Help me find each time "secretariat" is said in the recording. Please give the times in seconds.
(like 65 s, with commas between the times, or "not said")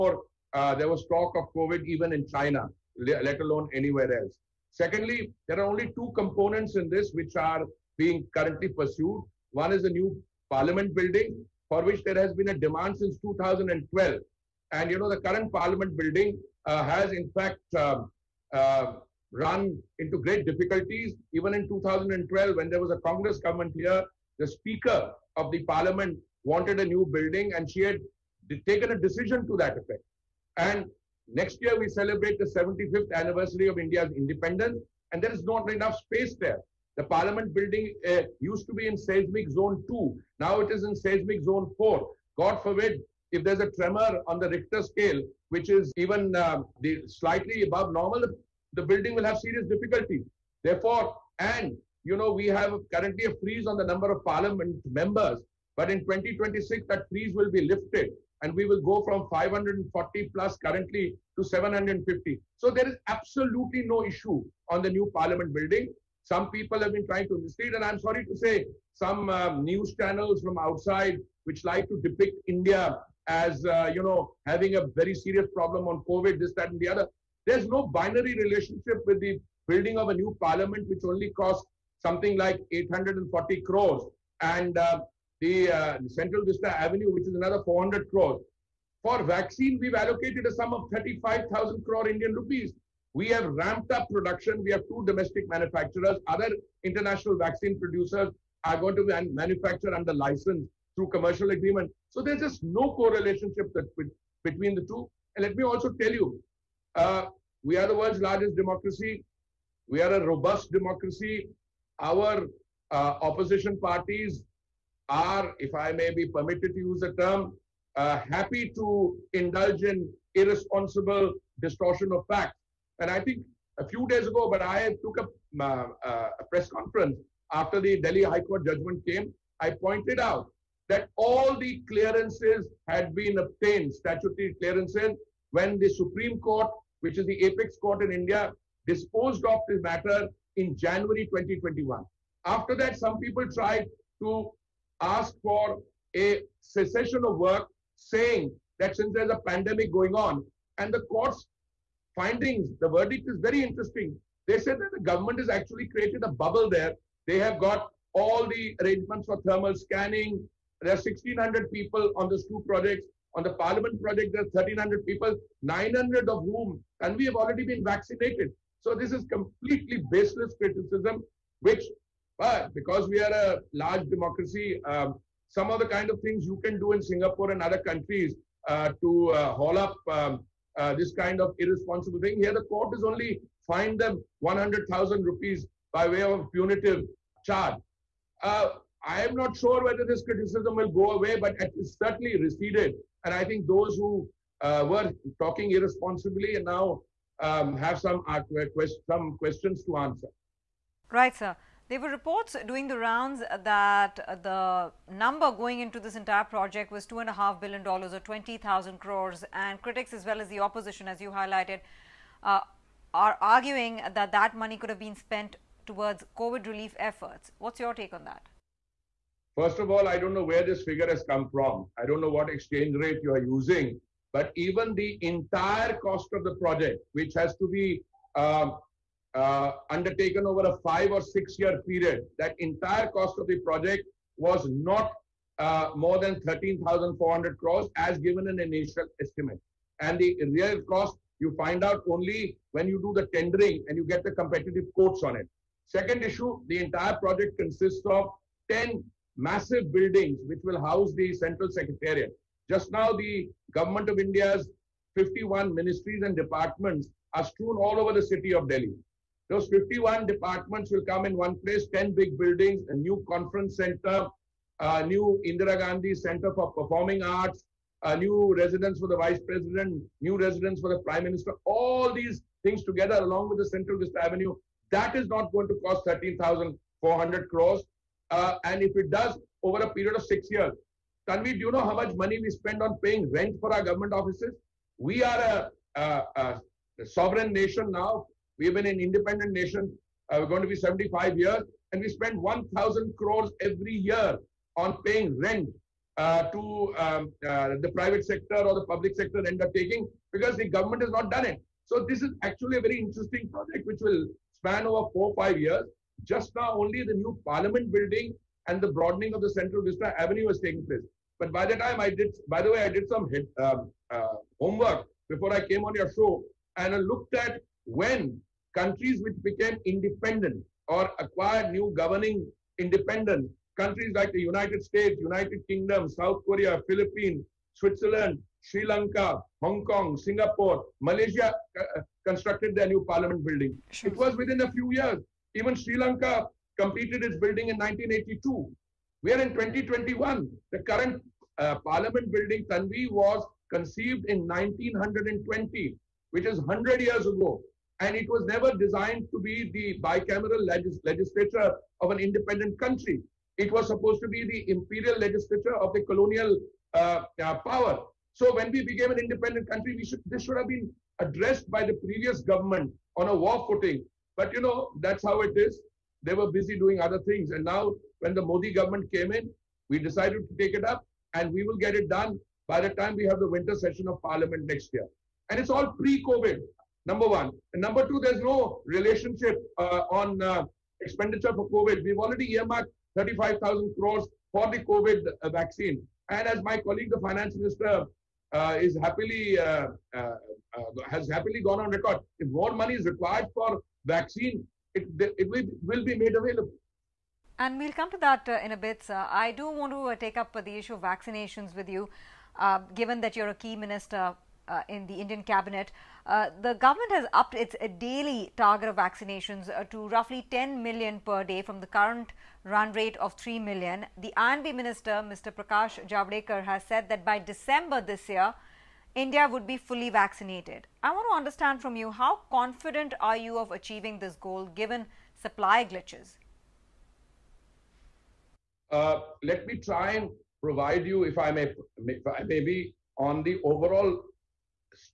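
251 s.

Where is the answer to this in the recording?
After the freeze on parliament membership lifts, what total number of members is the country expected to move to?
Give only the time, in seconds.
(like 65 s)
61 s.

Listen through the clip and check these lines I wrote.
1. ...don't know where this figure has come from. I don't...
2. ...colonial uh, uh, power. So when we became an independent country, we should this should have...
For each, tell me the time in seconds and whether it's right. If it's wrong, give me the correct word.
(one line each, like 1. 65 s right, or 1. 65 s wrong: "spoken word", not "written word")
1. 220 s right
2. 356 s right.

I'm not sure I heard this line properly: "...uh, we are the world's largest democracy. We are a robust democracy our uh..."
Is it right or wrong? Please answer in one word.
right.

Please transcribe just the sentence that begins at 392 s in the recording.
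If more money is required for vaccine, it, it will be made available.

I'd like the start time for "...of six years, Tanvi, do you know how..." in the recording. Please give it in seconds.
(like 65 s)
280 s.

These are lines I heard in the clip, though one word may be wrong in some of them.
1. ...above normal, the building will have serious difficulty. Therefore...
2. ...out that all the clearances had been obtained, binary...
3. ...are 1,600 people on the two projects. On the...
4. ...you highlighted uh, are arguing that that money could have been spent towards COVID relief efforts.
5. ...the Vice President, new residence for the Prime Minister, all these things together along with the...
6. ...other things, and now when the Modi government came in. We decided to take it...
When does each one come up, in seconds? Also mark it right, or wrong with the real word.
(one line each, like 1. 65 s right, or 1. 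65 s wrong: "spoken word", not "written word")
1. 47 s right
2. 130 s wrong: "statutory", not "binary"
3. 160 s right
4. 211 s right
5. 269 s right
6. 367 s right.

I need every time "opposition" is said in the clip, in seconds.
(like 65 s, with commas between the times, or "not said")
113 s, 210 s.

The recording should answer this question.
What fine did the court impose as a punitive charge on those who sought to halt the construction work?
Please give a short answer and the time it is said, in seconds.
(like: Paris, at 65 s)
100,000 rupees, at 184 s.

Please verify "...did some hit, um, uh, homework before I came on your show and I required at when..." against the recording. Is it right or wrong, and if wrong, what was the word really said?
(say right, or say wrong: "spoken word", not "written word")
wrong: "looked", not "required".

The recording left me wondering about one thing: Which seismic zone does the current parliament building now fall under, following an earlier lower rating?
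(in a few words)
4.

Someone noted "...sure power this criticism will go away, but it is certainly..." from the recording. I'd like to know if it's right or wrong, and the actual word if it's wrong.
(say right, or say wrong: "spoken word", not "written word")
wrong: "whether", not "power".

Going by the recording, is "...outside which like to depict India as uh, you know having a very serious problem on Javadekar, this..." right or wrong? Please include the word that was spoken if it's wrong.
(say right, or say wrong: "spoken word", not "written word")
wrong: "COVID", not "Javadekar".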